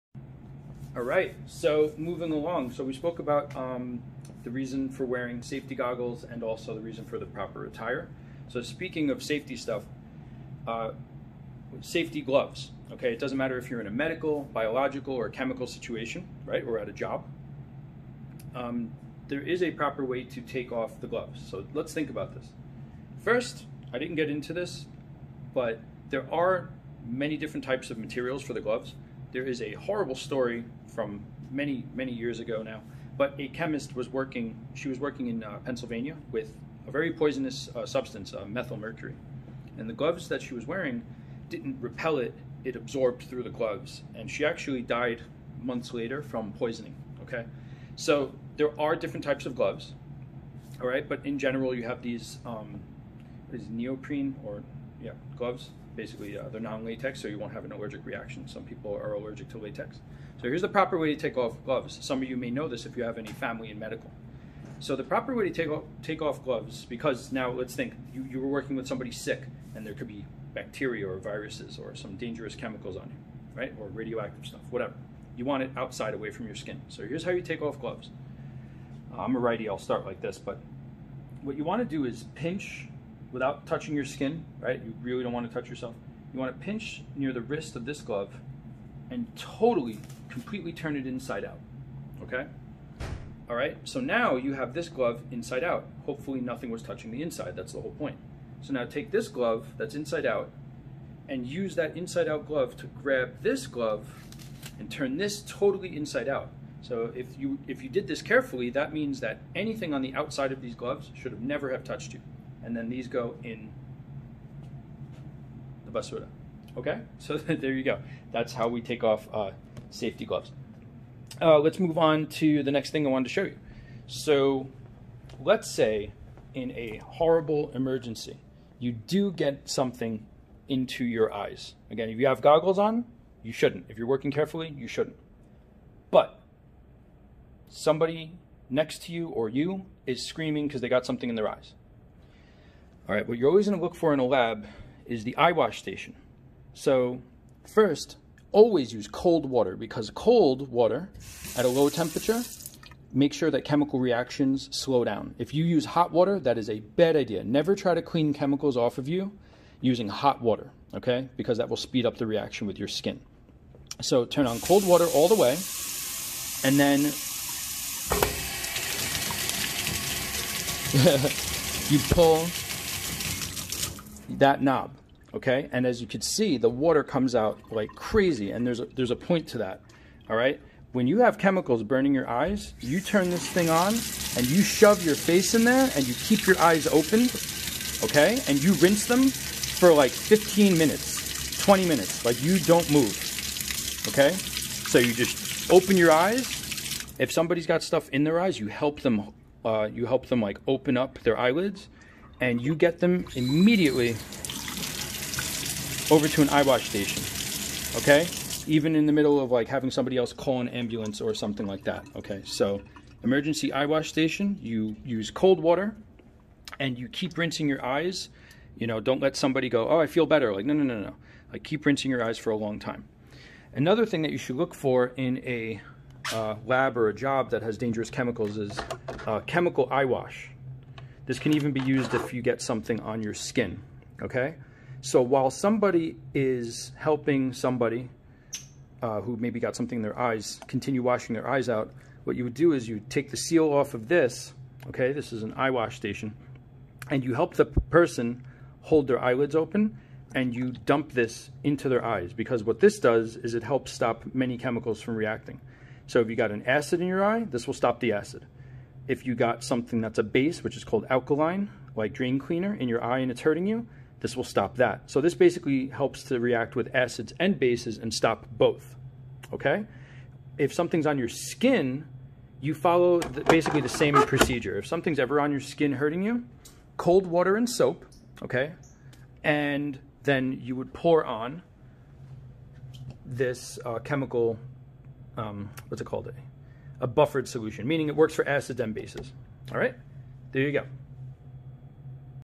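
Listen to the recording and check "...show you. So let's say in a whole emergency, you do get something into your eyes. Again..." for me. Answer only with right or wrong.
wrong.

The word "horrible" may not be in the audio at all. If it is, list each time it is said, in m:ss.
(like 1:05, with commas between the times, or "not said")
0:29, 2:07.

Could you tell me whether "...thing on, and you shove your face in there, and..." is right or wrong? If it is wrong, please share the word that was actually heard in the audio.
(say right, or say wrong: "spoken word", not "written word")
right.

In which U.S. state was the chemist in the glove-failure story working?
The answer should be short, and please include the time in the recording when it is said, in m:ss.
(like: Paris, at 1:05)
Pennsylvania, at 0:35.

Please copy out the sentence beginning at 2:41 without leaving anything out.
Because that will speed up the reaction with your skin.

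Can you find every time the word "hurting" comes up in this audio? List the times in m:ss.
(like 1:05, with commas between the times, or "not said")
4:23, 4:35.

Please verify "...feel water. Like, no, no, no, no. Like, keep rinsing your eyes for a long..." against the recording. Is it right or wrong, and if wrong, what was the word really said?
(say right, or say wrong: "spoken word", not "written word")
wrong: "better", not "water".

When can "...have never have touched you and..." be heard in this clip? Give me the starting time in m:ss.
1:51.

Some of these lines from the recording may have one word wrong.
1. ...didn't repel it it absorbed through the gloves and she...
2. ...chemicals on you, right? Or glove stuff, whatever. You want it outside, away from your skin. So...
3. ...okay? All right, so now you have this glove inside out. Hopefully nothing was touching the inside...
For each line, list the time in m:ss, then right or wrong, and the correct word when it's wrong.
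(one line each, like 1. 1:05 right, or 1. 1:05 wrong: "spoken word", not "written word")
1. 0:41 right
2. 1:12 wrong: "radioactive", not "glove"
3. 1:32 right.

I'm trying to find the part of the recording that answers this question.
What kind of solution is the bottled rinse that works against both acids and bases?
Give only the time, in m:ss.
4:47.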